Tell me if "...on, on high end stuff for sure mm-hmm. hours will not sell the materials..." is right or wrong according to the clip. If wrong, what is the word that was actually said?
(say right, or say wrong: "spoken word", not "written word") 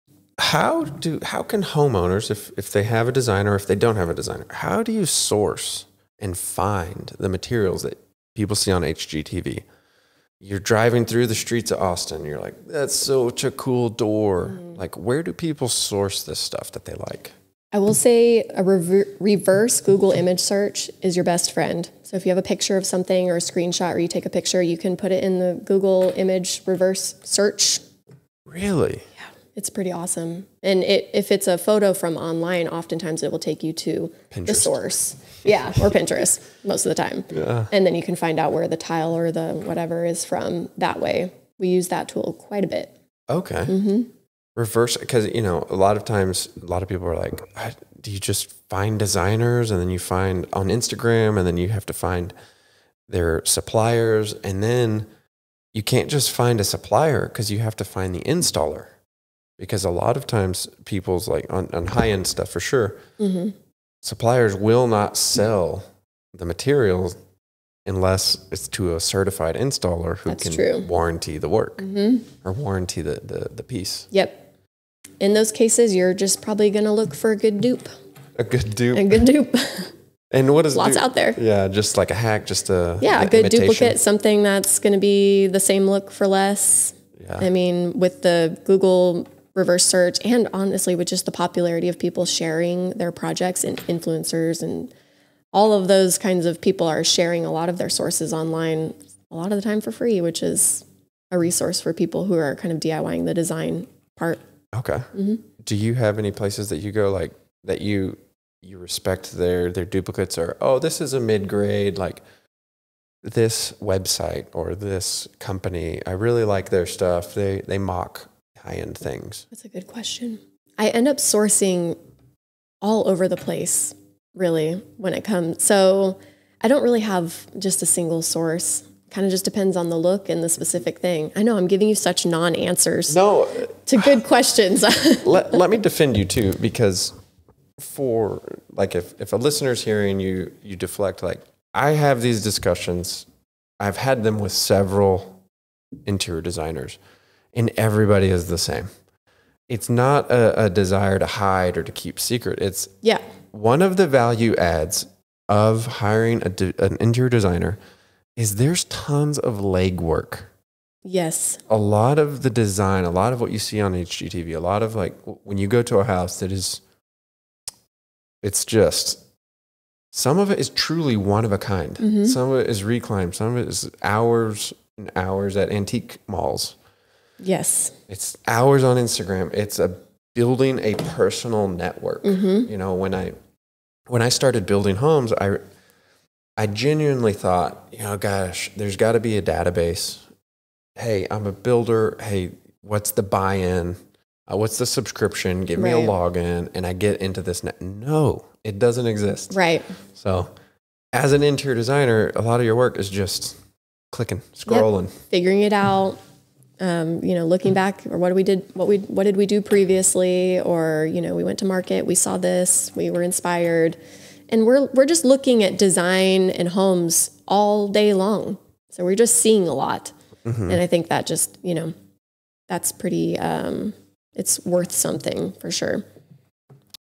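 wrong: "suppliers", not "hours".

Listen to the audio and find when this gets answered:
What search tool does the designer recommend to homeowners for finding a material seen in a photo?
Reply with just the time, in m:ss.
0:19.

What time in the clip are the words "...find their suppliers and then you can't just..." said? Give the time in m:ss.
0:51.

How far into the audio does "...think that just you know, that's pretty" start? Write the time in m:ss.
3:40.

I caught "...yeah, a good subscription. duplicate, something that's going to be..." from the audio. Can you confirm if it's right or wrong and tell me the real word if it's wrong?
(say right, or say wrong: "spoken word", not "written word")
wrong: "imitation", not "subscription".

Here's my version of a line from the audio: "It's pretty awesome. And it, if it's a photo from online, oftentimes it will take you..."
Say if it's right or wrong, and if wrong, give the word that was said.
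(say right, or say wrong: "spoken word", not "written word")
right.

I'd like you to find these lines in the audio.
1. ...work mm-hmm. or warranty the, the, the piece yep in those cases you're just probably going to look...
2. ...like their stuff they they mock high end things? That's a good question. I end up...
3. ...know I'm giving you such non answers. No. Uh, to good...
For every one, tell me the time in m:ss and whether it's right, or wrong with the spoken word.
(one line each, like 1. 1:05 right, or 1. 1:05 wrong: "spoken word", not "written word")
1. 1:11 right
2. 1:56 right
3. 2:11 right.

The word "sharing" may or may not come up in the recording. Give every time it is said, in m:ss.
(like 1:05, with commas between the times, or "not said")
1:32, 1:37.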